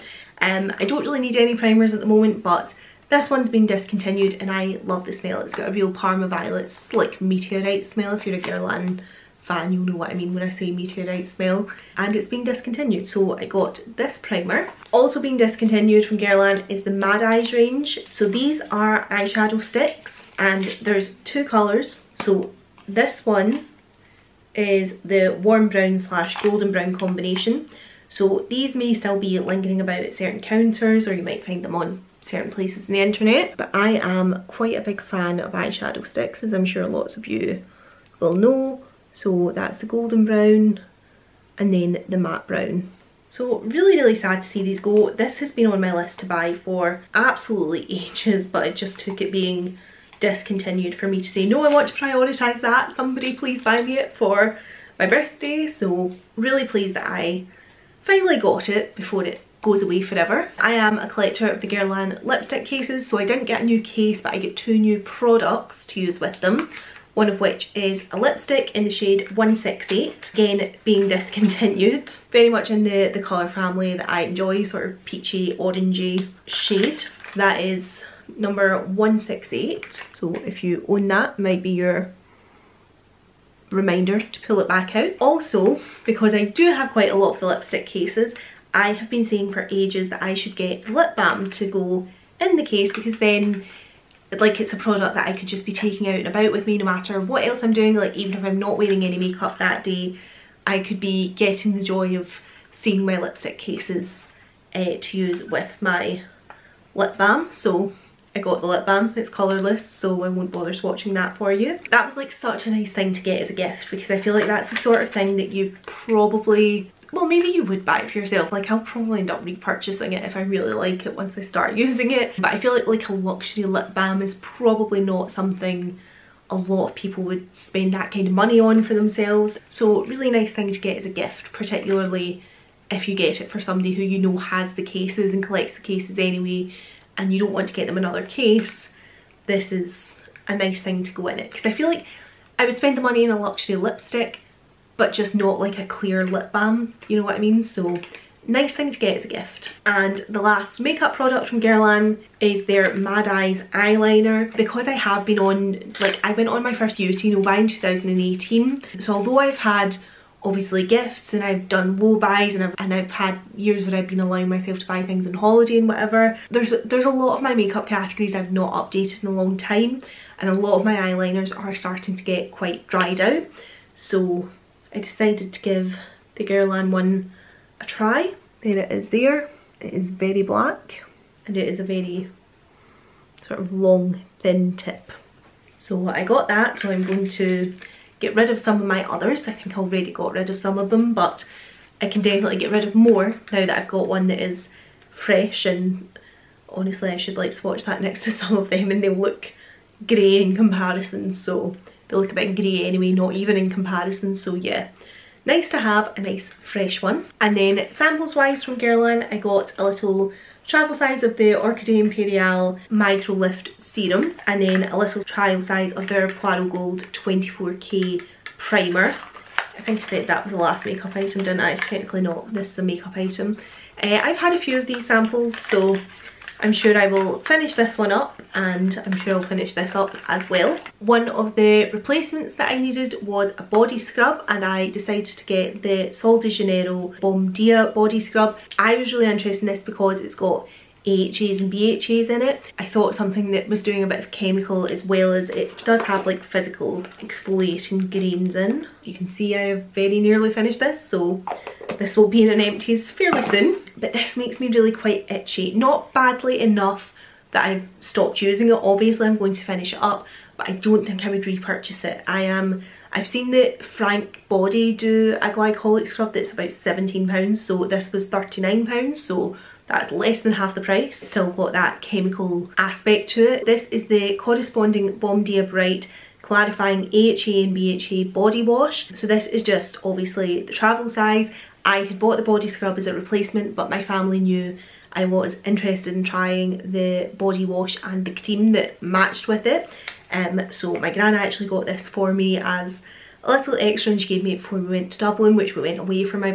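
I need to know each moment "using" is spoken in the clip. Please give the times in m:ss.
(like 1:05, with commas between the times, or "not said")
2:01, 4:18.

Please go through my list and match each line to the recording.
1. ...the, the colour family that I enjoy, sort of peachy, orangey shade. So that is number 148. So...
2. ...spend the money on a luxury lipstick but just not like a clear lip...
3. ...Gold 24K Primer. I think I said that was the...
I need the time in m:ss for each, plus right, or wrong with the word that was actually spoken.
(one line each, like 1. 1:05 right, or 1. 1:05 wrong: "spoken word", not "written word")
1. 1:12 wrong: "168", not "148"
2. 2:22 right
3. 3:36 right.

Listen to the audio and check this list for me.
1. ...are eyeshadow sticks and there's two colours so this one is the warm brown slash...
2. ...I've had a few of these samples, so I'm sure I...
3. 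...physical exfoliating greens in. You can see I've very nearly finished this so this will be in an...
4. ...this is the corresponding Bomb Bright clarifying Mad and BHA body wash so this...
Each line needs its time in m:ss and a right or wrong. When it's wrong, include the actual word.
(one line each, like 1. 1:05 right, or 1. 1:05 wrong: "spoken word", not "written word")
1. 0:18 right
2. 3:44 right
3. 4:06 right
4. 4:33 wrong: "AHA", not "Mad".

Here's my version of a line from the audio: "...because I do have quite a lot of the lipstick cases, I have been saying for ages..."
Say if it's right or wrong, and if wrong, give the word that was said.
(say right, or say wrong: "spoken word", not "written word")
right.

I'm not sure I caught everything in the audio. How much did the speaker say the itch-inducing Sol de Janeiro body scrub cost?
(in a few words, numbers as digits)
£39.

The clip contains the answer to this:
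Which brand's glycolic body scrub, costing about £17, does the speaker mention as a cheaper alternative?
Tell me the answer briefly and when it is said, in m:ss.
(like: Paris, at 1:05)
Frank Body, at 4:23.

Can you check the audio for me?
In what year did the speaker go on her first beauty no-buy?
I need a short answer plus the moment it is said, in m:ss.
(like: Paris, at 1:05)
2018, at 2:37.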